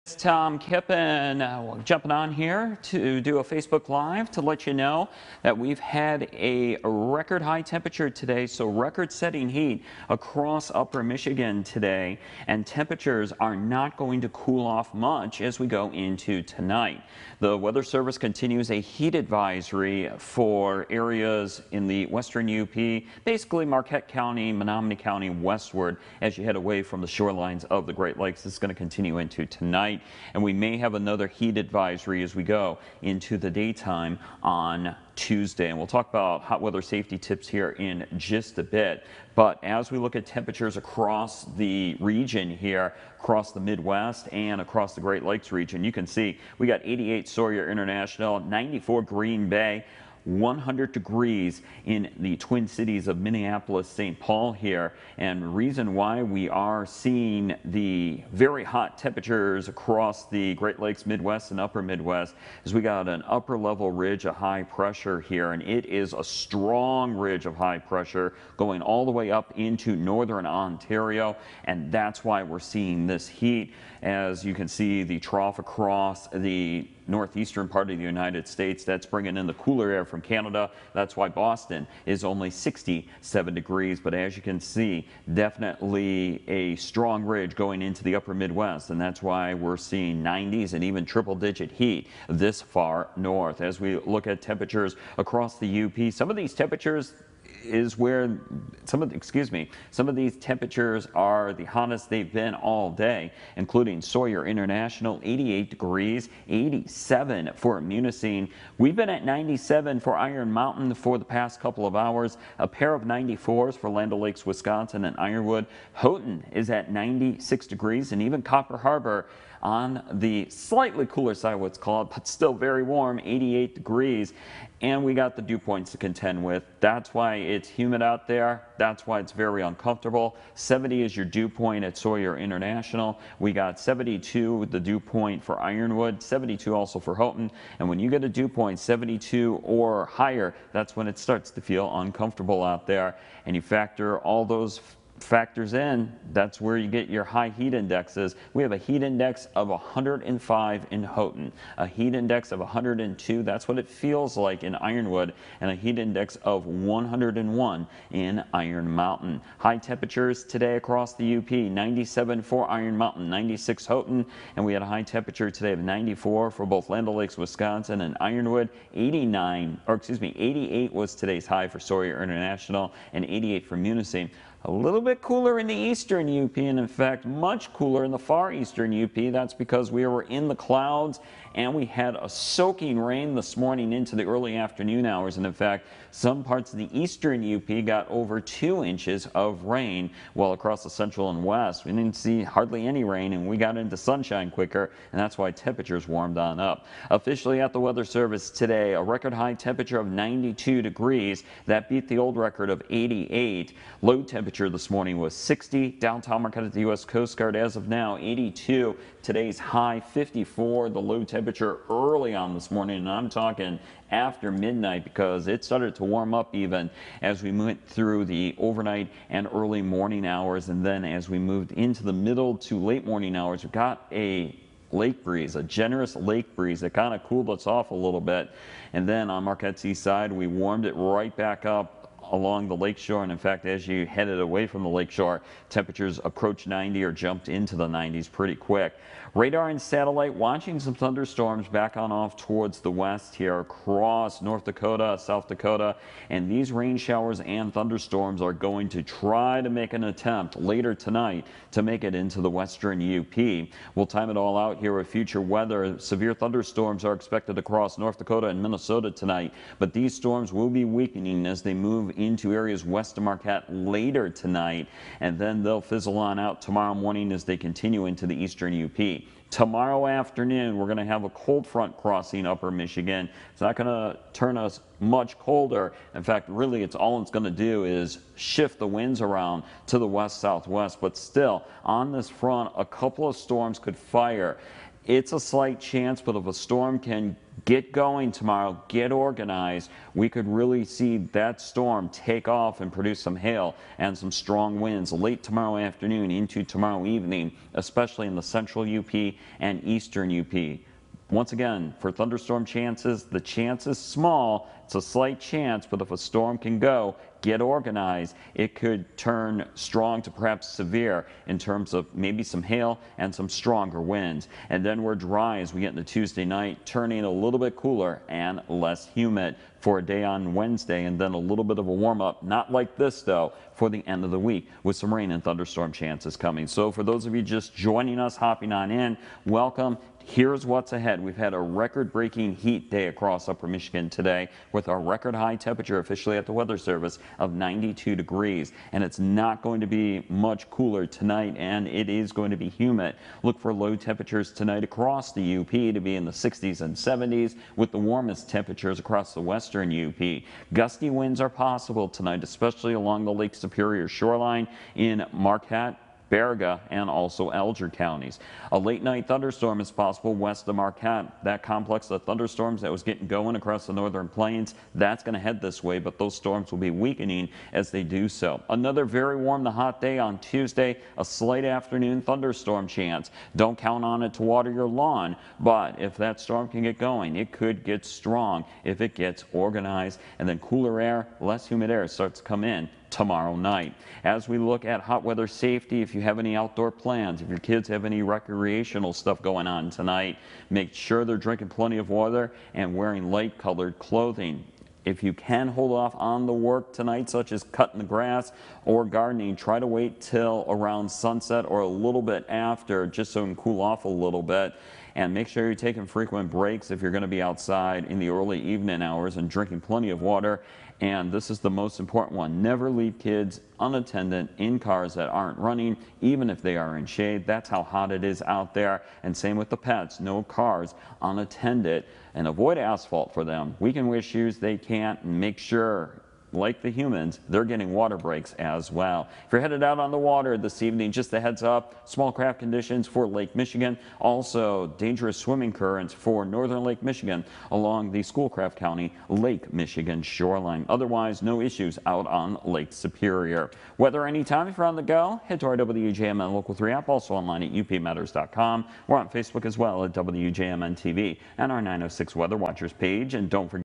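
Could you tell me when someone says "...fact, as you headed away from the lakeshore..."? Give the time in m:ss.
3:53.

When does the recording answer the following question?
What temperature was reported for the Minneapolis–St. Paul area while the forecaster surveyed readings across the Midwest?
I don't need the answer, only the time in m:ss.
0:50.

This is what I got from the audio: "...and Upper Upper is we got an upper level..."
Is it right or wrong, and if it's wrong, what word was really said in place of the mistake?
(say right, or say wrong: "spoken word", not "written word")
wrong: "Midwest", not "Upper".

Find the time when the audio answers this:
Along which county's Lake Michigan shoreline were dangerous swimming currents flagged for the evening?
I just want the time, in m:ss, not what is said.
7:18.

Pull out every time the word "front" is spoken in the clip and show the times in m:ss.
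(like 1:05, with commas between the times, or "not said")
4:31, 4:42.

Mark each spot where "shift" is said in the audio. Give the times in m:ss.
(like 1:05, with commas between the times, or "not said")
4:38.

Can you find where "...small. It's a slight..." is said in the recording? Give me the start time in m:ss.
5:03.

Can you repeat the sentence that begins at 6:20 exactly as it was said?
And then cooler air, less humid air starts to come in tomorrow night.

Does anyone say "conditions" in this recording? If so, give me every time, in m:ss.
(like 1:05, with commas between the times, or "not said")
7:12.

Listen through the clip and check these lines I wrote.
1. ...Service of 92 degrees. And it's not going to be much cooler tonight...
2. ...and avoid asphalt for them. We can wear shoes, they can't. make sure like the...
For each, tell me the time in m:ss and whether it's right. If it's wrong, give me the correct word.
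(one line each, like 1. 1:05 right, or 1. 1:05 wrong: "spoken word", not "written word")
1. 5:36 right
2. 7:02 right.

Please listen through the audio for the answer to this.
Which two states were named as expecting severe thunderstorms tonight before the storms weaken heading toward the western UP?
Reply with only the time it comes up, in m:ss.
4:17.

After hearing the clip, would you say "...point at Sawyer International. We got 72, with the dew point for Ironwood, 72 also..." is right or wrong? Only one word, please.
right.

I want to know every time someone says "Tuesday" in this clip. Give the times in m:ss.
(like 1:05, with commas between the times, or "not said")
0:35, 5:16, 6:10.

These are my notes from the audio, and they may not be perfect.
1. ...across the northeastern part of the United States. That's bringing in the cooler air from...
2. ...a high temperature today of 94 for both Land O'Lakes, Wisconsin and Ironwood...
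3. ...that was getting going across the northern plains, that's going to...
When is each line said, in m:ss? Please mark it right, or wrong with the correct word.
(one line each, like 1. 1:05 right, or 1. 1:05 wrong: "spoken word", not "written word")
1. 1:15 right
2. 2:44 right
3. 6:02 right.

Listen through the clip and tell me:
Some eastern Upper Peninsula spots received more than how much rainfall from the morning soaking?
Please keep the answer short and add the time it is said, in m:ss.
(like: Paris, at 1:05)
2 inches, at 3:08.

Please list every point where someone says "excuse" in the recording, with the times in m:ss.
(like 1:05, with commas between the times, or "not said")
1:39, 2:49.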